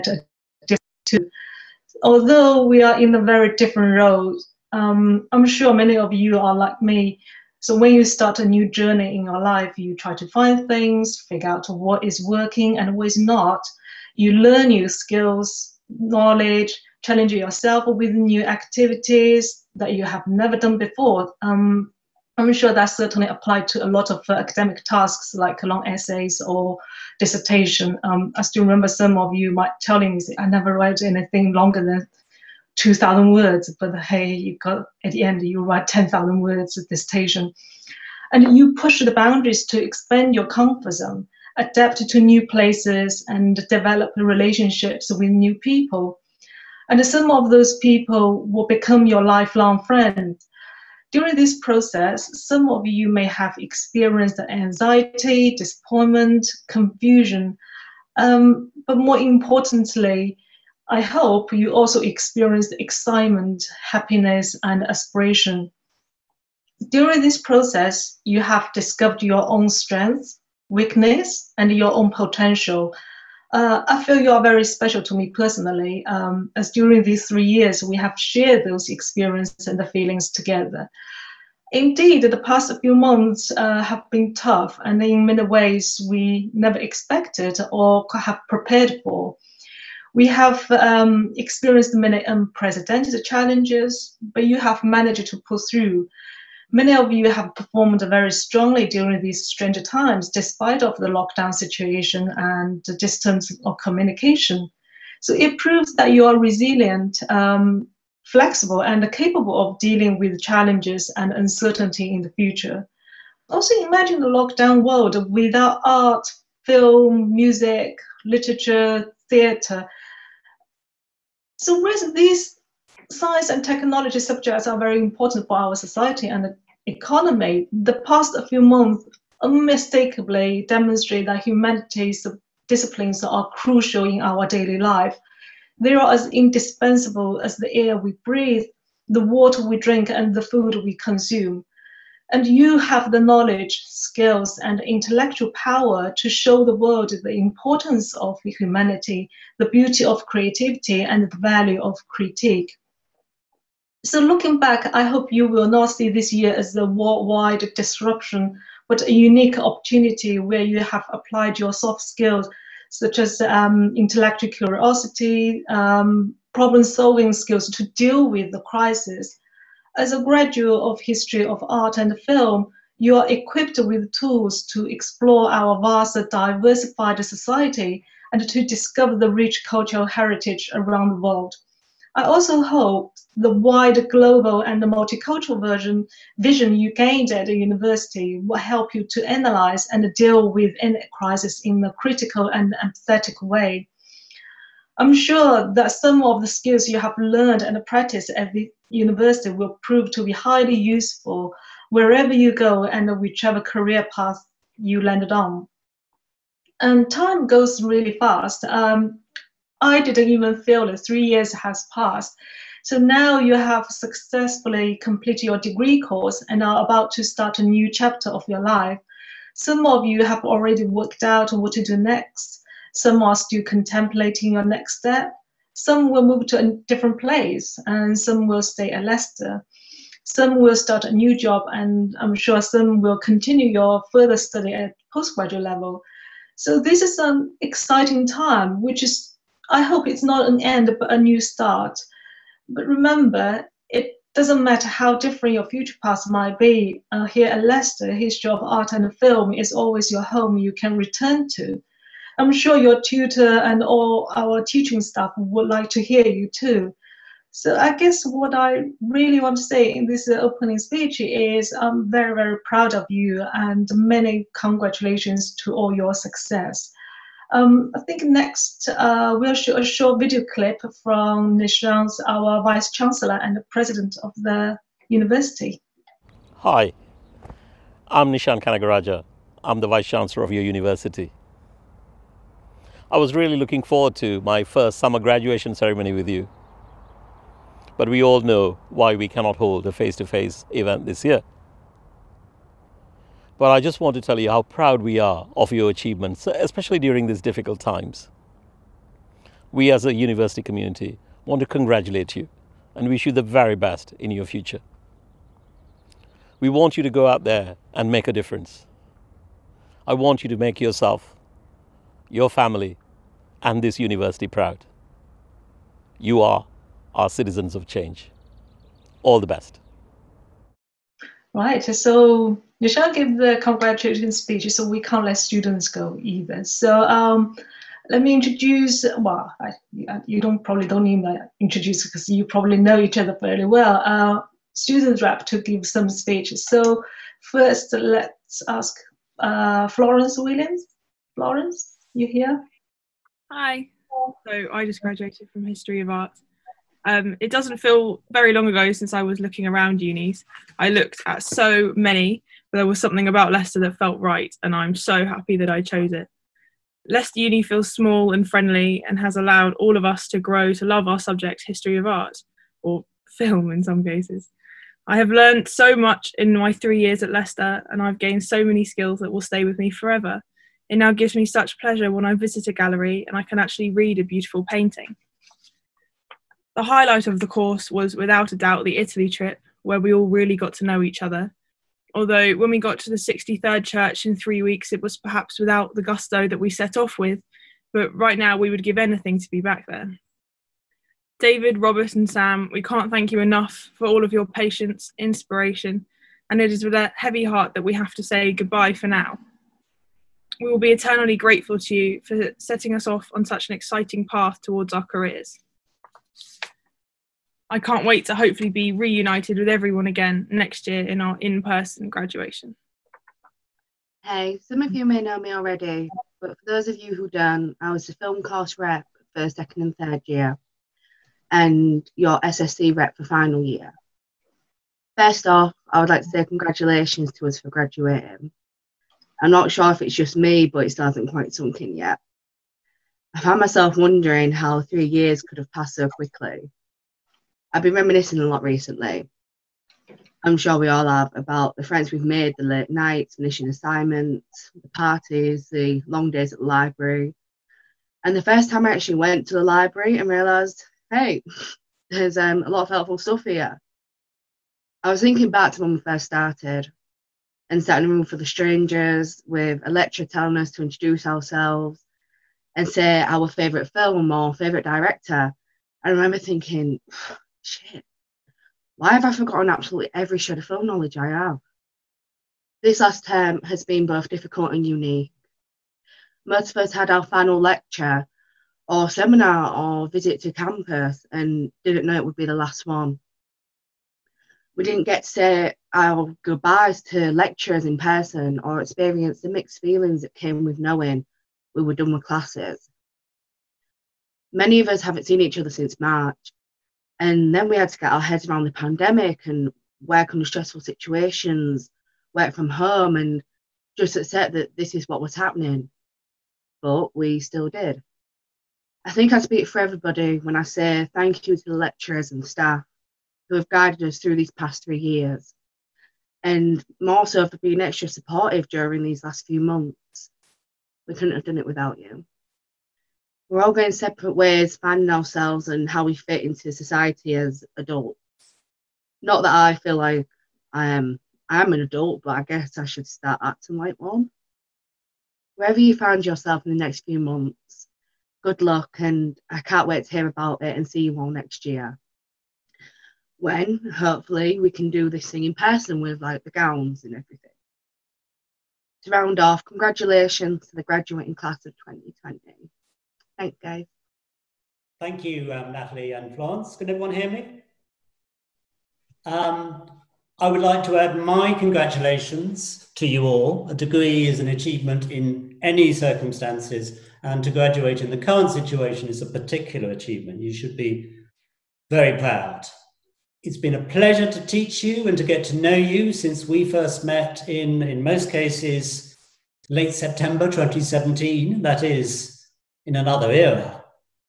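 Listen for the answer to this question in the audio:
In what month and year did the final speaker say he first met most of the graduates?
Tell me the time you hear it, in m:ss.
9:39.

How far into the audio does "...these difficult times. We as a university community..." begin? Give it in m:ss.
4:57.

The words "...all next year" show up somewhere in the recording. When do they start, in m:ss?
9:01.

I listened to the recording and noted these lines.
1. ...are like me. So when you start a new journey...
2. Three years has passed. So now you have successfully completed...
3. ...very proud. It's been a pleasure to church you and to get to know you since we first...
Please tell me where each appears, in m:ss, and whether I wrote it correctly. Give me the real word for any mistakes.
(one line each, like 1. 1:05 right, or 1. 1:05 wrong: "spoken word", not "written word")
1. 0:06 right
2. 3:31 right
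3. 9:31 wrong: "teach", not "church".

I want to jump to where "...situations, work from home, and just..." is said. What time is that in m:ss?
8:20.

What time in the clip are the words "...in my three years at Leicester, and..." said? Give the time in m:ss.
6:06.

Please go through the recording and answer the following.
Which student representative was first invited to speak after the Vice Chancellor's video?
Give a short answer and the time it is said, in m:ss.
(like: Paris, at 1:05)
Florence Williams, at 5:39.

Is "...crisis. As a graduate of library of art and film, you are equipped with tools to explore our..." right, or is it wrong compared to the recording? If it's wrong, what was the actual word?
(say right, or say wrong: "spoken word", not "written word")
wrong: "history", not "library".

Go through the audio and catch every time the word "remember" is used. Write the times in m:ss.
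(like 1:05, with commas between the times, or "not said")
0:28, 4:02, 7:46.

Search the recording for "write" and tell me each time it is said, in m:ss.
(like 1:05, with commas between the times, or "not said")
0:30, 0:35.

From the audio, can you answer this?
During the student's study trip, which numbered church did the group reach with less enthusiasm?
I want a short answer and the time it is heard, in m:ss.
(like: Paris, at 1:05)
63rd, at 6:23.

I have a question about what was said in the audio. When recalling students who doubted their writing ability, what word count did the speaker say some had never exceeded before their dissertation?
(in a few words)
2,000 words.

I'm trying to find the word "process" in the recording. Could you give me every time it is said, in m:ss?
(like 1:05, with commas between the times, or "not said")
0:51, 1:07.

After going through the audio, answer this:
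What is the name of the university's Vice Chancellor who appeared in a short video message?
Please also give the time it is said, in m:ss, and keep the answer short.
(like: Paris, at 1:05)
Nishan Canagarajah, at 4:38.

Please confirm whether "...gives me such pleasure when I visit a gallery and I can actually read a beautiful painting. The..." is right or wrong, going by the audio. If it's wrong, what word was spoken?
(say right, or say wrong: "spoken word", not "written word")
right.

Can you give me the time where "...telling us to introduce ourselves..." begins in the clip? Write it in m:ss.
7:40.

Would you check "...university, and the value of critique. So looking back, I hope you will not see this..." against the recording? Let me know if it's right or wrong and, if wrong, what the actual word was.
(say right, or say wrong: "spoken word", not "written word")
wrong: "creativity", not "university".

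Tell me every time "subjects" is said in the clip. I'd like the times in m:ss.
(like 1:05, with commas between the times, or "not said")
2:04, 6:01.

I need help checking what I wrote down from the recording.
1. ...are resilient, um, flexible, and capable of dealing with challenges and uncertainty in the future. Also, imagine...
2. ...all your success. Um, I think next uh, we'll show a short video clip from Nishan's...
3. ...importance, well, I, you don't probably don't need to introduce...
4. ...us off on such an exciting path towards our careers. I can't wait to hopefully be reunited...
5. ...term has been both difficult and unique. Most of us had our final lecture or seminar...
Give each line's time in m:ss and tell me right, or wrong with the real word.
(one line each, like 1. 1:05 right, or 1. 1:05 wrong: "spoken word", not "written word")
1. 1:46 right
2. 4:25 right
3. 5:28 wrong: "introduce", not "importance"
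4. 6:42 right
5. 7:53 right.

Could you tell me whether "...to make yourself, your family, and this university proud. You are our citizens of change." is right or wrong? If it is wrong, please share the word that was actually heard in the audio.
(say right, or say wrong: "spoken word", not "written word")
right.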